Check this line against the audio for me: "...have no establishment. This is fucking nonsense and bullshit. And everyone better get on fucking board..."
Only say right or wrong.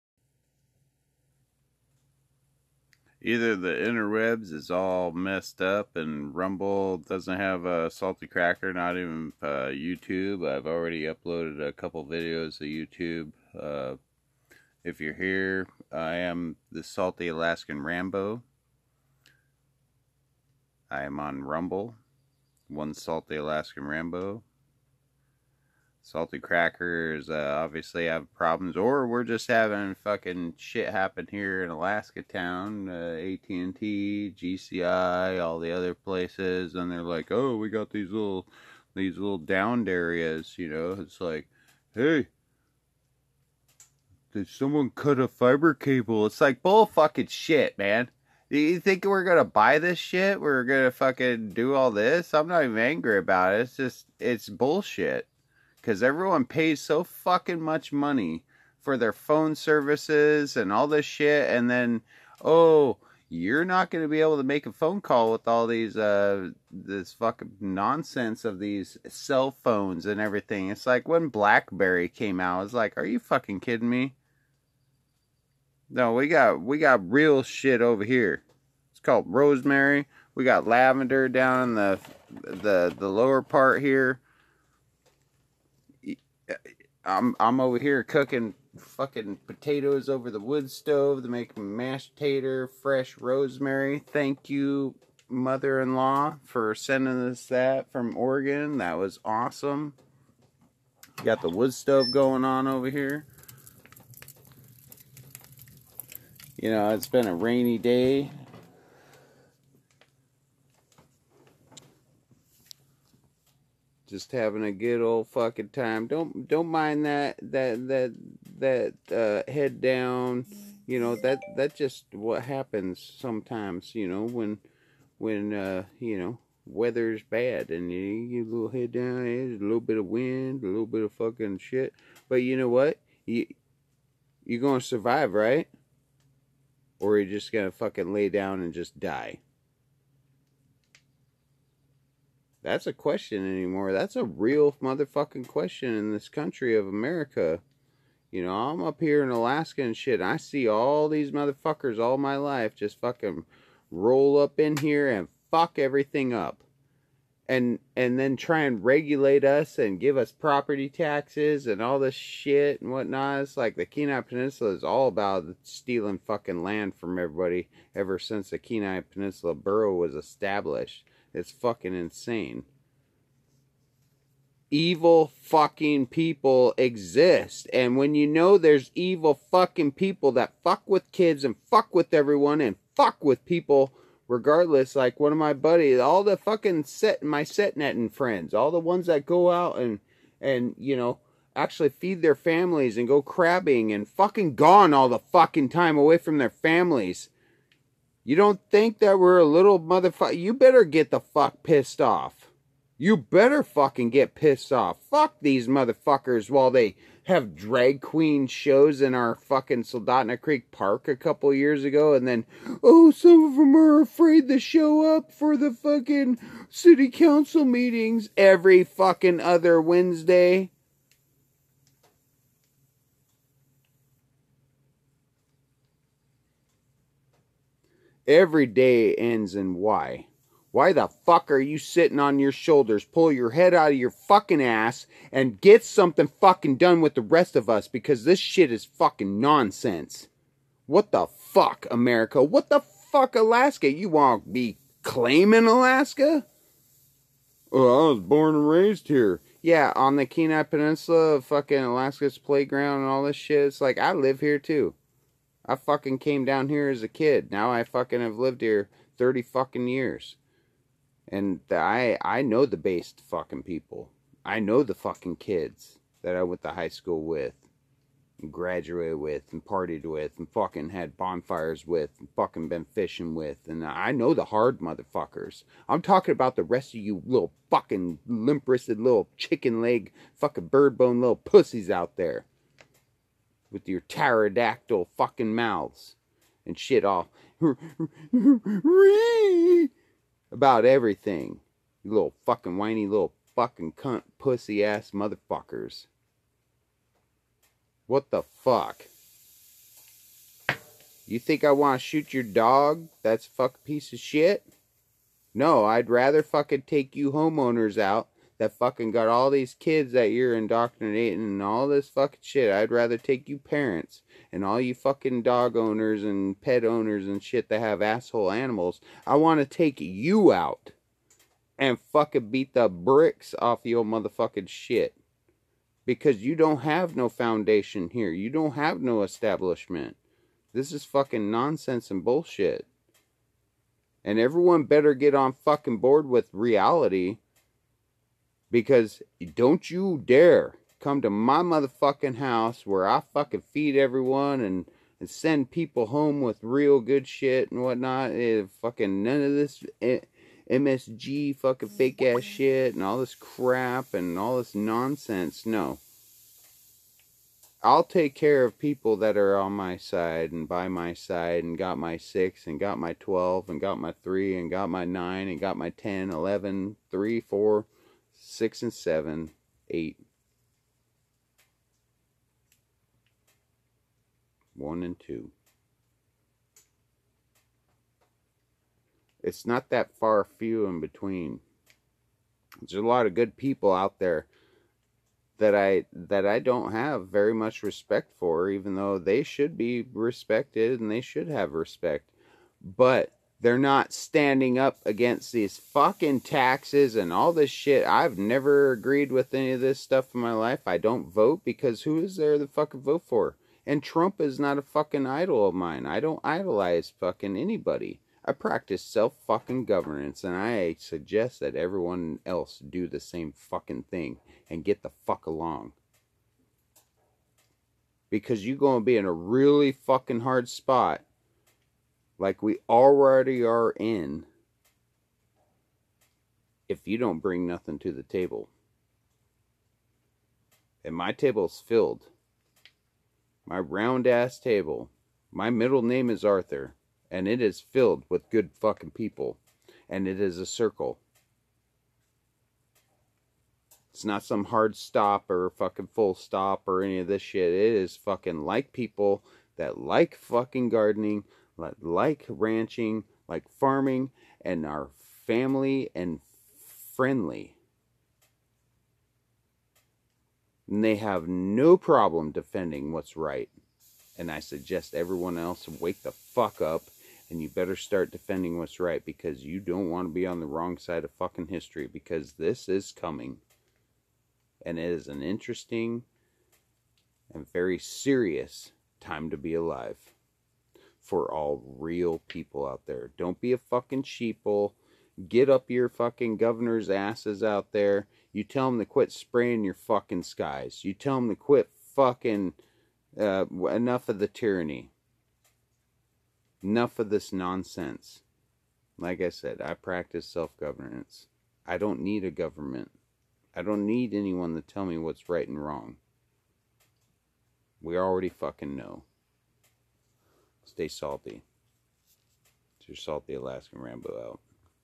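right.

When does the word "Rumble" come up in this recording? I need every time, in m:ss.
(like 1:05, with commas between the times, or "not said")
0:06, 0:21.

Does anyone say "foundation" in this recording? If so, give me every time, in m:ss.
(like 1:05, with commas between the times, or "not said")
5:27.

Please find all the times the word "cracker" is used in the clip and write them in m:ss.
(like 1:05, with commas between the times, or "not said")
0:08, 0:26.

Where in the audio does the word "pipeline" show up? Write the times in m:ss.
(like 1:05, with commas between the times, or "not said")
not said.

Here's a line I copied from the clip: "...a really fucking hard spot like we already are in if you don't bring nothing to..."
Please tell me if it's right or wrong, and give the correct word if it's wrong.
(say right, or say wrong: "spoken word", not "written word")
right.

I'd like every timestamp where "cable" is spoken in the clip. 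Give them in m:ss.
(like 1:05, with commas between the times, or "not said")
0:45.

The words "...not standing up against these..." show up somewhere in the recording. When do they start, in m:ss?
6:33.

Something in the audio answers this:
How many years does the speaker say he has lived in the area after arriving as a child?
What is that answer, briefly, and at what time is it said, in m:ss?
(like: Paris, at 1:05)
30, at 4:19.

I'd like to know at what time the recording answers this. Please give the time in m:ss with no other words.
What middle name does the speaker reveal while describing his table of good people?
7:16.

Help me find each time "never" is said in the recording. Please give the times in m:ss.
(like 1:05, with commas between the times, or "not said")
6:38.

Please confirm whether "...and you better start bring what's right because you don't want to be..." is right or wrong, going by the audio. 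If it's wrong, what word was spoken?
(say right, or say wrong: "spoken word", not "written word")
wrong: "defending", not "bring".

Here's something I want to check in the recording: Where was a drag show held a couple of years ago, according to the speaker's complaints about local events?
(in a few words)
Soldotna Creek Park.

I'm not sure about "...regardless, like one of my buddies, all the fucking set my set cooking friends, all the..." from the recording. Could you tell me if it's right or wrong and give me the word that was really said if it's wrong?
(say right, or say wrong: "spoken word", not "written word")
wrong: "netting", not "cooking".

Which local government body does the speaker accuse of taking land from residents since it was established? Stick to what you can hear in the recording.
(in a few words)
Kenai Peninsula Borough.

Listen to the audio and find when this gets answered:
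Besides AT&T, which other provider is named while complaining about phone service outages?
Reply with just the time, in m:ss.
0:34.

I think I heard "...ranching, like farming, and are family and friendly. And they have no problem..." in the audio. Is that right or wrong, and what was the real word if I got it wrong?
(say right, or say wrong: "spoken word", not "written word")
right.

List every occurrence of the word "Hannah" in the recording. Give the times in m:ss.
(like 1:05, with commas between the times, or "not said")
not said.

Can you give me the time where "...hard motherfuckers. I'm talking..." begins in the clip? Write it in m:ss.
4:34.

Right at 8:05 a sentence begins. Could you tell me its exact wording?
Get up your fucking governor's asses out there.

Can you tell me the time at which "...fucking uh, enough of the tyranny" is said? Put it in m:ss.
8:12.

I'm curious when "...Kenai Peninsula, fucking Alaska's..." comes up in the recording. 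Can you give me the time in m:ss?
4:10.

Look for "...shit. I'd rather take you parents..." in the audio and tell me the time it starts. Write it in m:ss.
5:12.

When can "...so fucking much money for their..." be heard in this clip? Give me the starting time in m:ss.
0:56.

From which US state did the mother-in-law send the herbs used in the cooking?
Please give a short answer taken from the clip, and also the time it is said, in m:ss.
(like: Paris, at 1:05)
Oregon, at 1:38.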